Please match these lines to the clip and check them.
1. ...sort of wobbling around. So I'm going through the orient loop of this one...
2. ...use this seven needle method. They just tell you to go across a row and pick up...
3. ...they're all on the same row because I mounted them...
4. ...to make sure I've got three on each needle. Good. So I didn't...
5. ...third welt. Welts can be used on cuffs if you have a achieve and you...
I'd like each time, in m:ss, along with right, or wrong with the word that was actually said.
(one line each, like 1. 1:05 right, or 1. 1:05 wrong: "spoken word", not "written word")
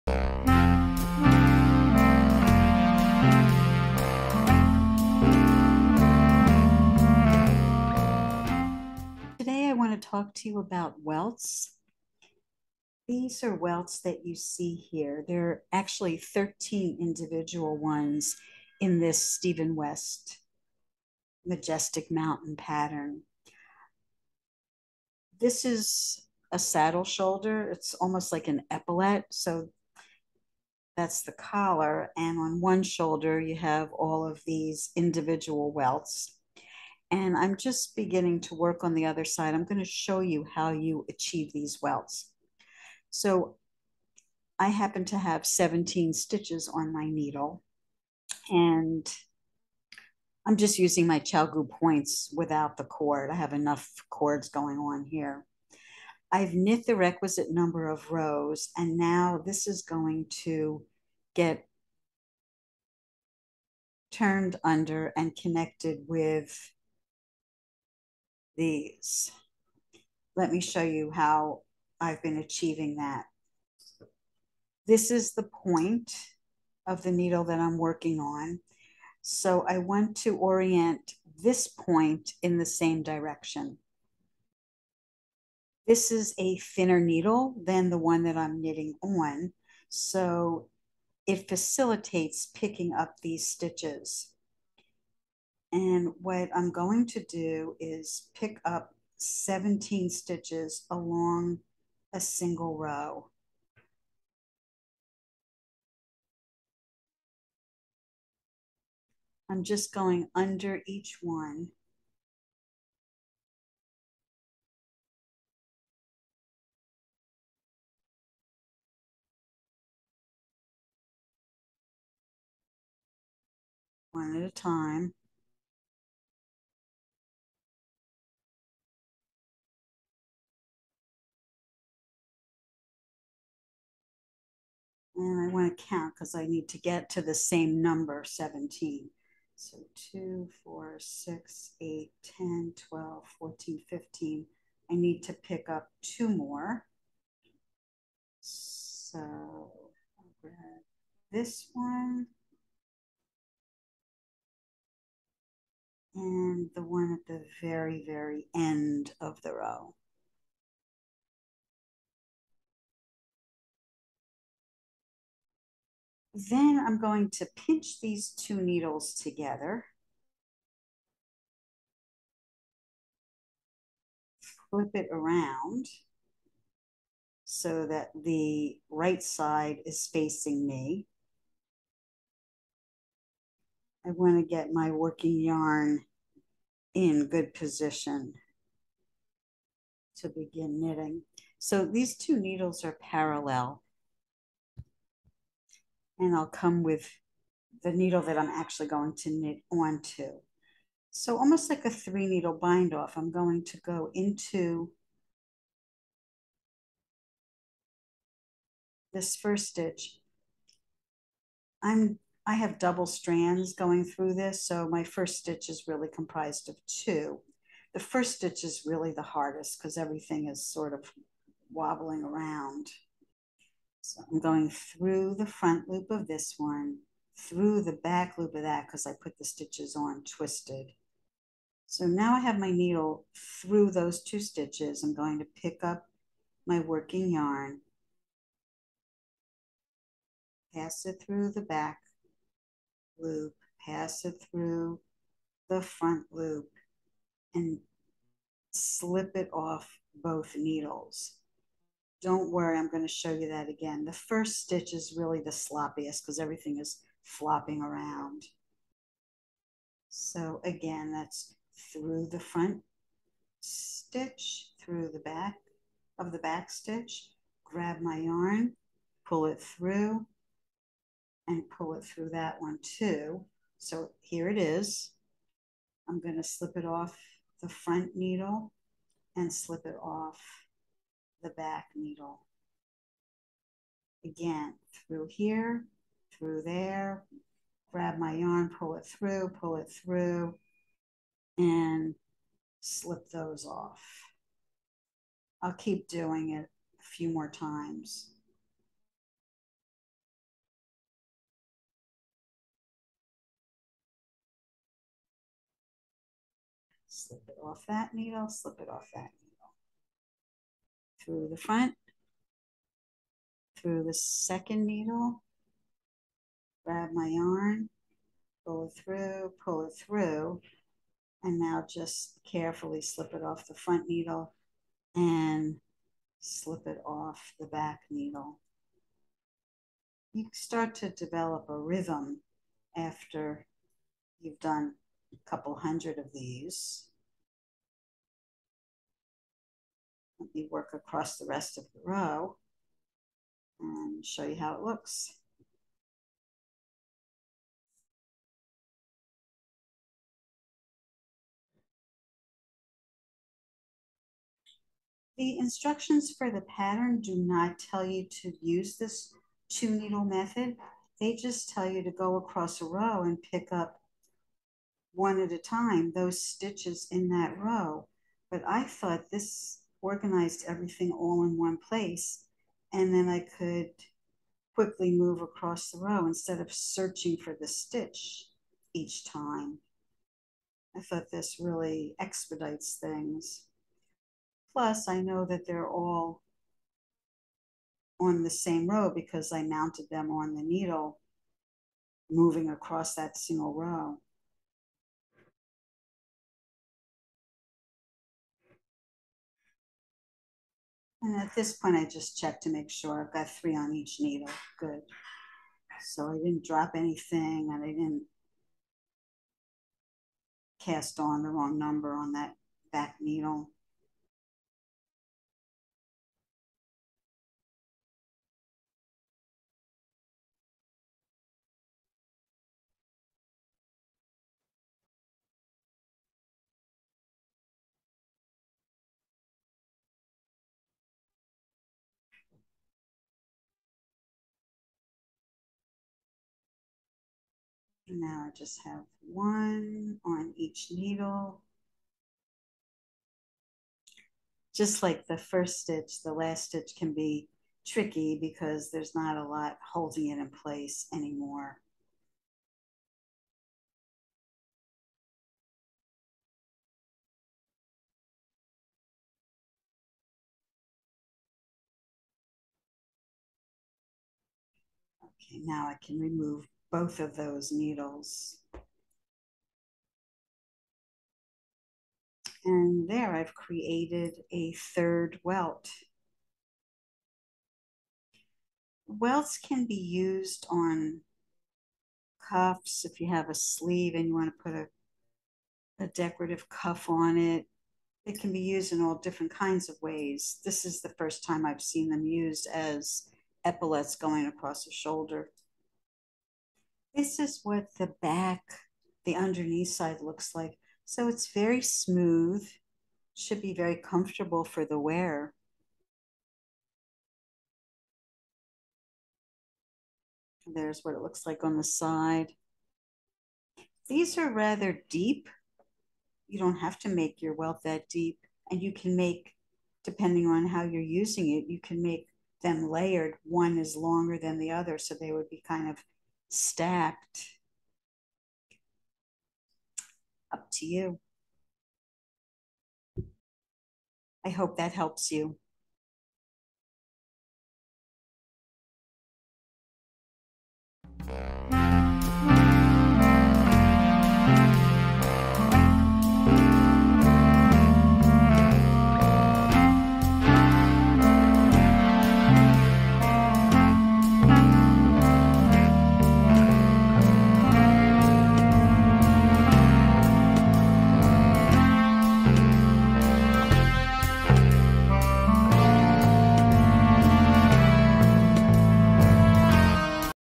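1. 3:40 wrong: "front", not "orient"
2. 5:58 wrong: "two", not "seven"
3. 6:25 right
4. 6:42 right
5. 7:54 wrong: "sleeve", not "achieve".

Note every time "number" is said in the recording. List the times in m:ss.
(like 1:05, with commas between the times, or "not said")
0:57, 2:17, 6:51.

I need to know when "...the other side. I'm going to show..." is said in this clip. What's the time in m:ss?
0:38.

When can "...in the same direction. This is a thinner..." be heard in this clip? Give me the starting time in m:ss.
1:22.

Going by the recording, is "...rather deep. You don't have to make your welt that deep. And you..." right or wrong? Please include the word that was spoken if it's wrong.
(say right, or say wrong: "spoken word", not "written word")
right.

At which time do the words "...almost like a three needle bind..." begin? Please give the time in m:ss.
3:21.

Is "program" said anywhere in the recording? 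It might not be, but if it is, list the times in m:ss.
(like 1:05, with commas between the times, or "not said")
not said.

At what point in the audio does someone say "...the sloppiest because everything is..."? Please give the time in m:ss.
4:15.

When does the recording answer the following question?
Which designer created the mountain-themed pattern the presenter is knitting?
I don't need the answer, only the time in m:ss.
0:19.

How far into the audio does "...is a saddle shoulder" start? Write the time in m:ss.
0:25.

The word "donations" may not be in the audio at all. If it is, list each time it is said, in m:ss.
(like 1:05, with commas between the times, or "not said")
not said.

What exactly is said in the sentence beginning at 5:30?
You start to develop a rhythm after you've done a couple hundred of these.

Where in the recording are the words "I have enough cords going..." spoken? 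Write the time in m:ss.
0:53.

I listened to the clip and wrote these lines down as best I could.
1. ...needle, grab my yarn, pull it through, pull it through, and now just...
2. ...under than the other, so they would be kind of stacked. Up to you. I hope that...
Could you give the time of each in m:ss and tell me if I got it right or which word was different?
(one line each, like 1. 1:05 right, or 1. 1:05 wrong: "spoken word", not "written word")
1. 5:14 right
2. 8:43 wrong: "longer", not "under".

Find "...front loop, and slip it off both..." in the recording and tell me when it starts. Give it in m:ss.
4:05.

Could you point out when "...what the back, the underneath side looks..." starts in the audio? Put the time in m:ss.
8:17.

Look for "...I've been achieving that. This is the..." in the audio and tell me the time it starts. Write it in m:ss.
1:11.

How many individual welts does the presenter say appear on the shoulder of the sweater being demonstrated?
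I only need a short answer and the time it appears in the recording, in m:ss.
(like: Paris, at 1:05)
13, at 0:16.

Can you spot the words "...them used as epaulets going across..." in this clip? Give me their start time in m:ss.
8:12.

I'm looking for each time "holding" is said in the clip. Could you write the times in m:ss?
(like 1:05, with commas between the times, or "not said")
7:29.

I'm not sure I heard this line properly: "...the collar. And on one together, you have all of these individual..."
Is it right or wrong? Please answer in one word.
wrong.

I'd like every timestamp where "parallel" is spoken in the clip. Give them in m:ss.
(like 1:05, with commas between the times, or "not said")
3:13.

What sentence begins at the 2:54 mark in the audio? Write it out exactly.
Flip it around so that the right side is facing me.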